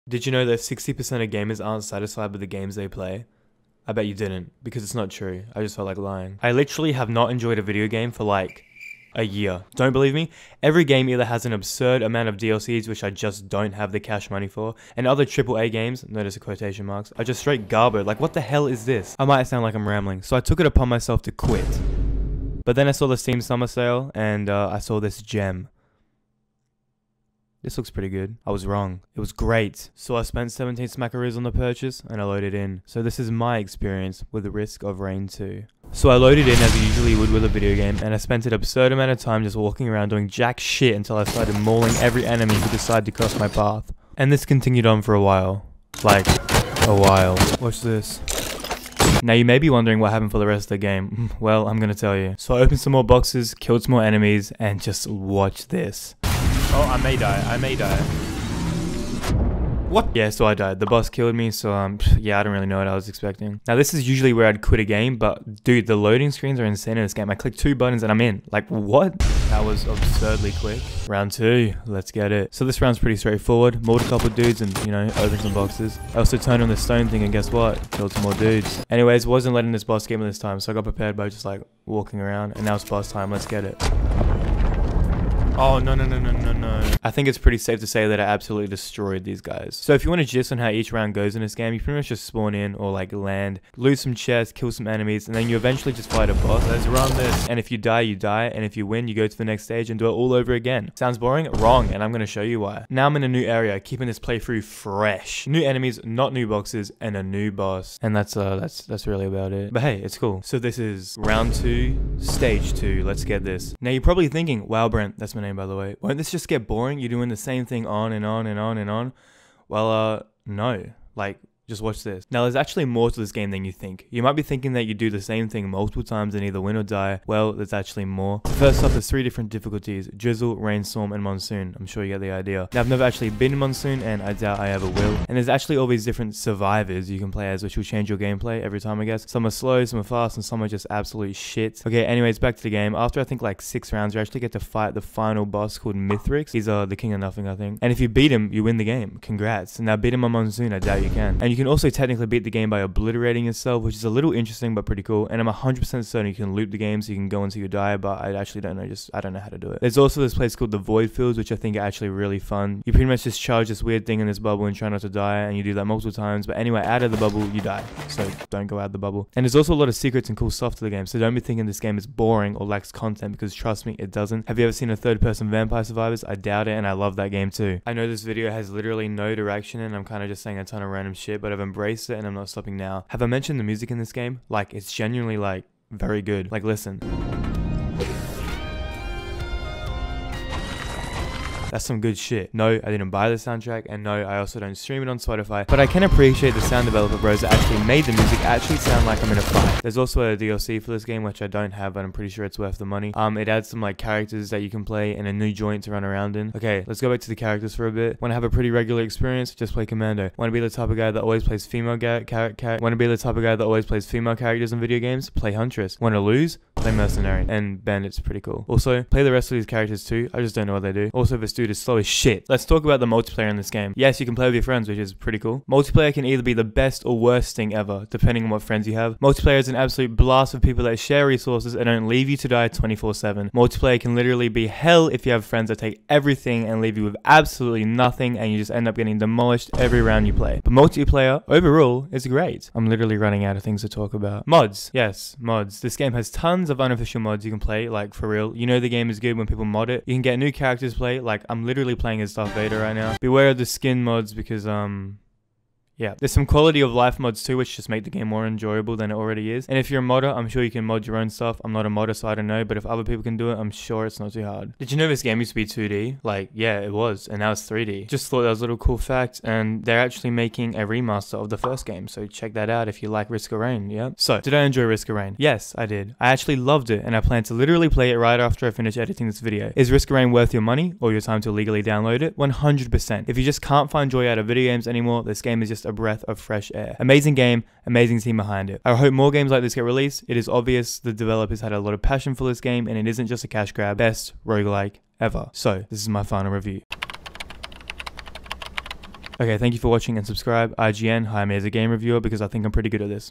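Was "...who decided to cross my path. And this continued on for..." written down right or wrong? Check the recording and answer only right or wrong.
right.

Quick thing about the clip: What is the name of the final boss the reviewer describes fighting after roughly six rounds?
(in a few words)
Mithrix.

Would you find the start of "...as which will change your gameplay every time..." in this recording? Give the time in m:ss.
2:17.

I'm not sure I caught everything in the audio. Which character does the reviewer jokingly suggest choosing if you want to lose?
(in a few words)
Mercenary.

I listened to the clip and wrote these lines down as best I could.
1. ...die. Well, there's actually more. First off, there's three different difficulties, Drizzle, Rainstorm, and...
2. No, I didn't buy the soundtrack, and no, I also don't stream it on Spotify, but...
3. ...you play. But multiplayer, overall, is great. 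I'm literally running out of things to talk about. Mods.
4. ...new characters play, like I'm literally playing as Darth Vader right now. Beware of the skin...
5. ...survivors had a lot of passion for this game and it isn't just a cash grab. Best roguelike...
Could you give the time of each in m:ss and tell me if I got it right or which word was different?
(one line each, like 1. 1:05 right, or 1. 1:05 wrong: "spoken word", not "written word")
1. 2:06 right
2. 3:12 right
3. 4:00 right
4. 4:10 right
5. 4:51 wrong: "developers", not "survivors".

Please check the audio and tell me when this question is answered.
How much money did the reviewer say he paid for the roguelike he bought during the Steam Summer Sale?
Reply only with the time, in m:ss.
0:30.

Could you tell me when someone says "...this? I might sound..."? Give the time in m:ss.
0:18.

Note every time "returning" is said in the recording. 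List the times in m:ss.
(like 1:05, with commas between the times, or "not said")
not said.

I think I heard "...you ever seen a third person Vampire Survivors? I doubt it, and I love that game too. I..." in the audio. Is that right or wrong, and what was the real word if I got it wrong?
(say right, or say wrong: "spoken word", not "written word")
right.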